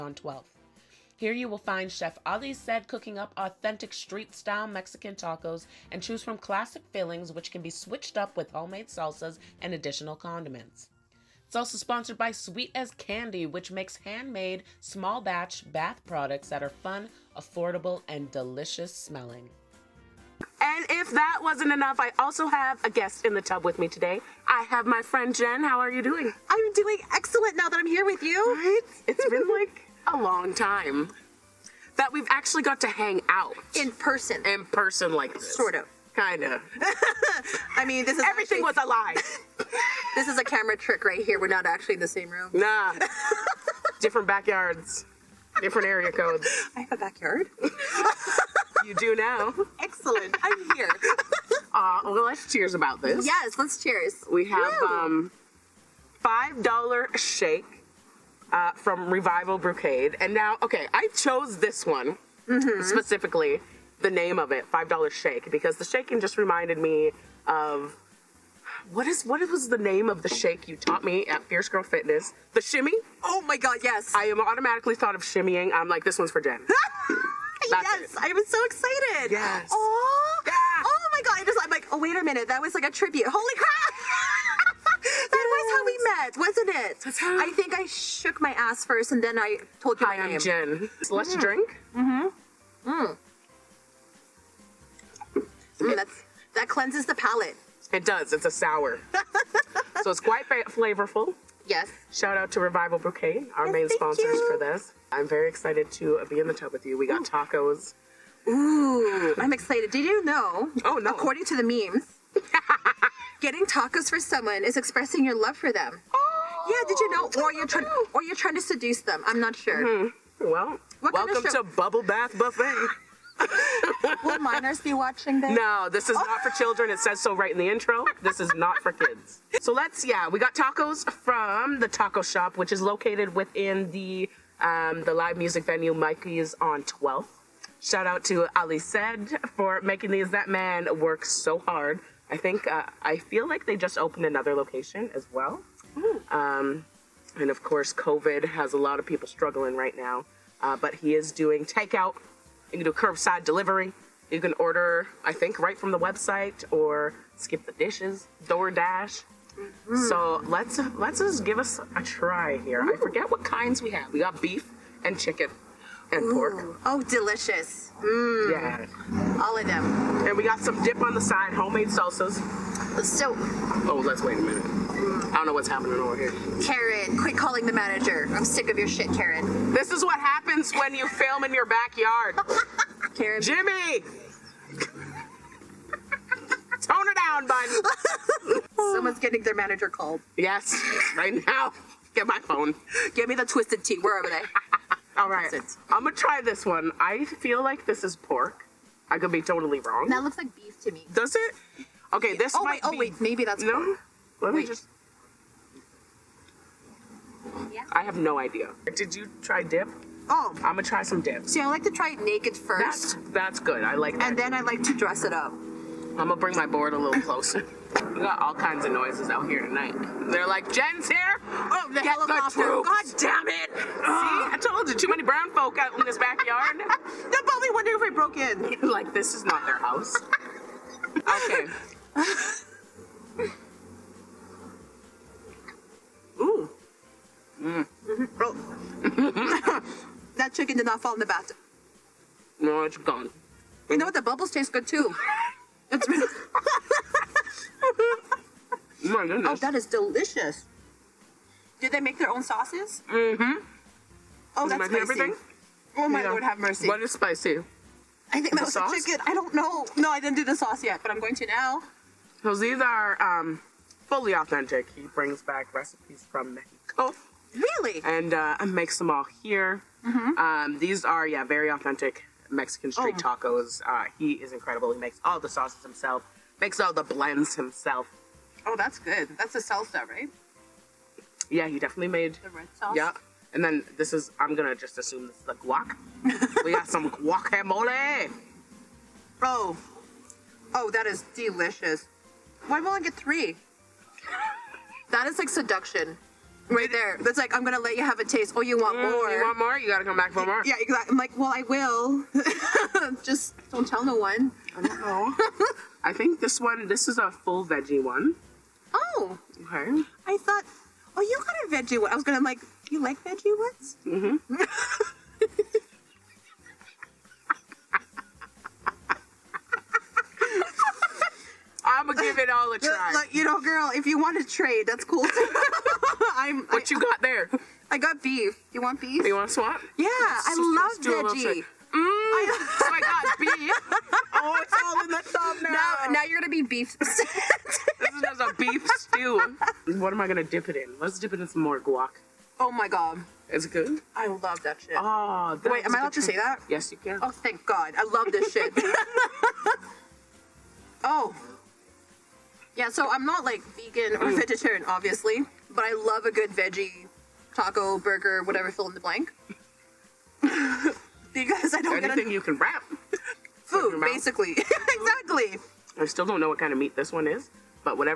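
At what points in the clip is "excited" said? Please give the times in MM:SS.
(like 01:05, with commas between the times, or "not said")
01:18, 01:45, 01:49.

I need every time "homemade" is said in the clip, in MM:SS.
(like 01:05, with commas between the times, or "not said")
00:08, 02:51.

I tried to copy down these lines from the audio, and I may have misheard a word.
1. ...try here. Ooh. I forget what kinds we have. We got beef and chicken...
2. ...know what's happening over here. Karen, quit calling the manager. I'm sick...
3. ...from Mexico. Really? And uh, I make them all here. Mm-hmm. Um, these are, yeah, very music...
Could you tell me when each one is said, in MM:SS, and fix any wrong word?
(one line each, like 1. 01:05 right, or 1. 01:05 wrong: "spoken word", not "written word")
1. 02:42 right
2. 02:55 right
3. 04:26 wrong: "authentic", not "music".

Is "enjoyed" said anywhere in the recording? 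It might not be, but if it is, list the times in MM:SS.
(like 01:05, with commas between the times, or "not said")
not said.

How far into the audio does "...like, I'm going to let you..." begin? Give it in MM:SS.
04:57.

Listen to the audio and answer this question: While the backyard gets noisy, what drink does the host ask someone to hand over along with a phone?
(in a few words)
Twisted Tea.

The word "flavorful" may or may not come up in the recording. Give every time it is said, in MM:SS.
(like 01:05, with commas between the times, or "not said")
01:40.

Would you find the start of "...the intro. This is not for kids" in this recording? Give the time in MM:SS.
02:07.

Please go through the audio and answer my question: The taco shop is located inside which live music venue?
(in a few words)
Mikey's on 12th.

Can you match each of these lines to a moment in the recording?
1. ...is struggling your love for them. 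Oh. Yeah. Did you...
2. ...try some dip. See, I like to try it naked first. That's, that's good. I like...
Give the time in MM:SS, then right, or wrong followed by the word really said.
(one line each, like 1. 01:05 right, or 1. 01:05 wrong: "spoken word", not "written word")
1. 01:54 wrong: "expressing", not "struggling"
2. 03:30 right.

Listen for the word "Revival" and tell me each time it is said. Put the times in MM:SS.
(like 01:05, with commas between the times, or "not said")
00:59, 01:42.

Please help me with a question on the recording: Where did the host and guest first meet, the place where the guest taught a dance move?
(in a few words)
Fierce Girl Fitness.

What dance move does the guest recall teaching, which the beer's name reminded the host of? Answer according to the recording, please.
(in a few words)
The shimmy.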